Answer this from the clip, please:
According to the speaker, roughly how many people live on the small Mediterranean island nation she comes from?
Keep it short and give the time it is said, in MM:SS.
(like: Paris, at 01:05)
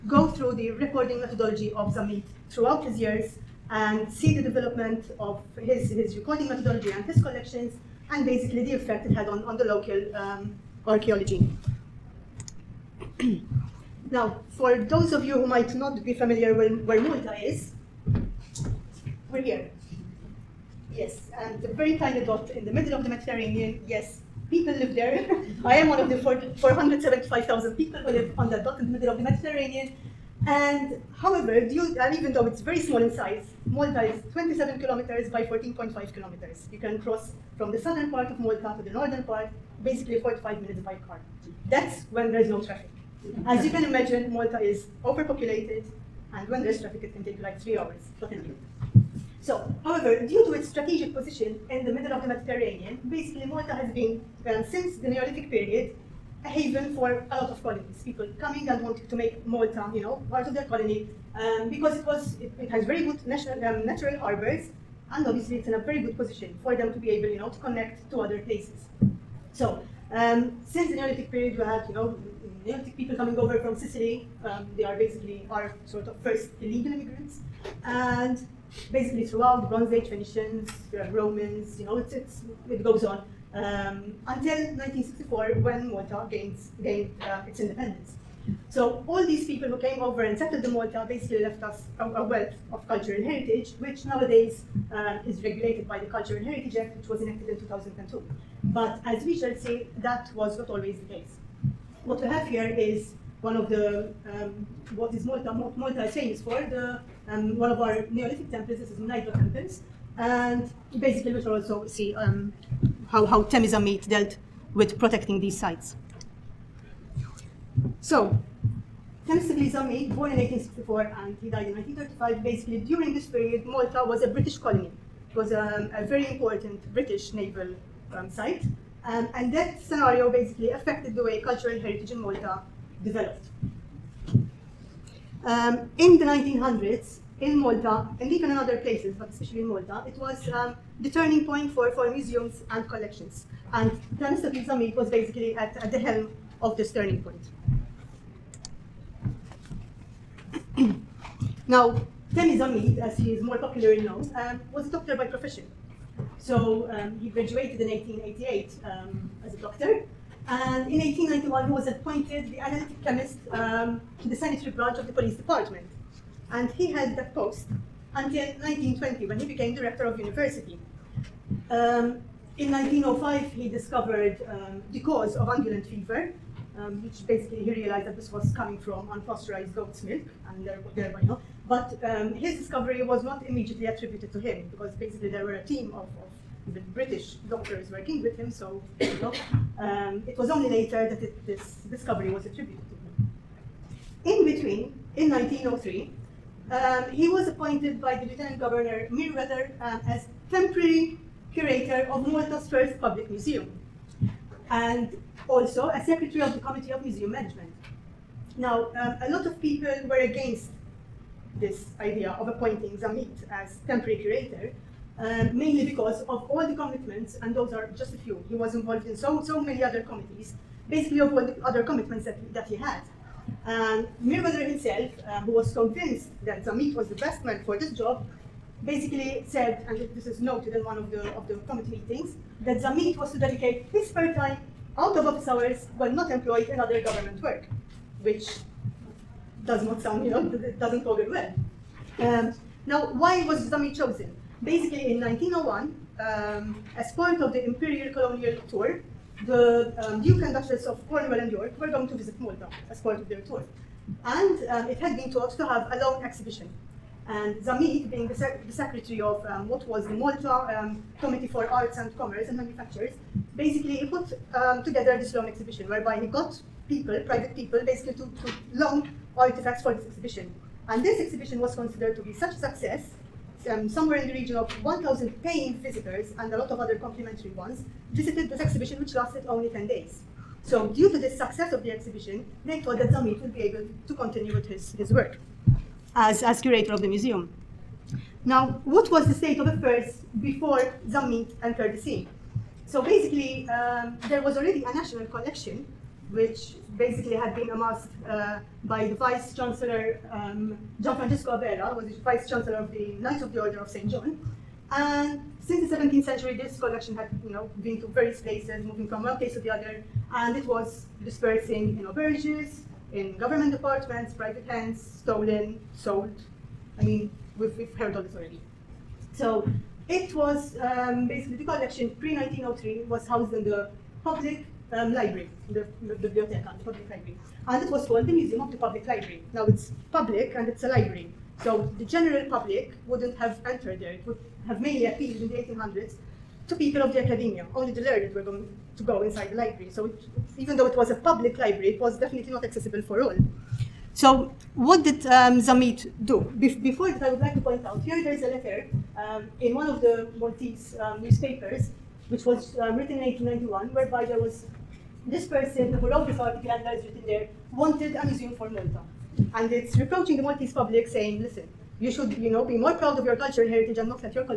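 475,000, at 00:26.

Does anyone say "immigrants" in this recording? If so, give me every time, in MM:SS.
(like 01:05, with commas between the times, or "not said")
01:16.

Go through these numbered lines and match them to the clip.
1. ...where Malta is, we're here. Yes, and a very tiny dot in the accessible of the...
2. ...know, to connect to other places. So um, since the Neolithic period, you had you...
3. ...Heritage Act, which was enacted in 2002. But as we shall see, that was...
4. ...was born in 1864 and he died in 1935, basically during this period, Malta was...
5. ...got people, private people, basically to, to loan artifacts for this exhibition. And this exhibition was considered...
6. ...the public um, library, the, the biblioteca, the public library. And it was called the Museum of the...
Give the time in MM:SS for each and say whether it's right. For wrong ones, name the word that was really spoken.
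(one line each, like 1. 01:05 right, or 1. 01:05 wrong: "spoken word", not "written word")
1. 00:16 wrong: "middle", not "accessible"
2. 01:07 right
3. 01:36 right
4. 01:59 right
5. 04:26 right
6. 05:23 right.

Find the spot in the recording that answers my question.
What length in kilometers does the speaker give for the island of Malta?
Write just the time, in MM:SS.
00:34.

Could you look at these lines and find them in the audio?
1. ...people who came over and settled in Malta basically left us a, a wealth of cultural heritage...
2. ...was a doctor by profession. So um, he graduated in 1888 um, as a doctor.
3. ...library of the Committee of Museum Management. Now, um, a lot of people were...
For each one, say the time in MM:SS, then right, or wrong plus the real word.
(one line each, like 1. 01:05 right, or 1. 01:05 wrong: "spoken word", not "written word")
1. 01:29 right
2. 02:34 right
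3. 03:26 wrong: "secretary", not "library".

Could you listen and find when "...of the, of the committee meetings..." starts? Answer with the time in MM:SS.
03:50.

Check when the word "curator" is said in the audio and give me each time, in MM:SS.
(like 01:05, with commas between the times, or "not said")
03:21, 03:34, 04:46.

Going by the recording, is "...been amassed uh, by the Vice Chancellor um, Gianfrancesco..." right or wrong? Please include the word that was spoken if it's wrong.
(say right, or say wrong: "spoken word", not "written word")
right.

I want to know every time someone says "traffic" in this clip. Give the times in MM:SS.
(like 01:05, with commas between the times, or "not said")
00:42, 00:46.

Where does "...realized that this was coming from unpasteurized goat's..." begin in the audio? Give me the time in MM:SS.
02:57.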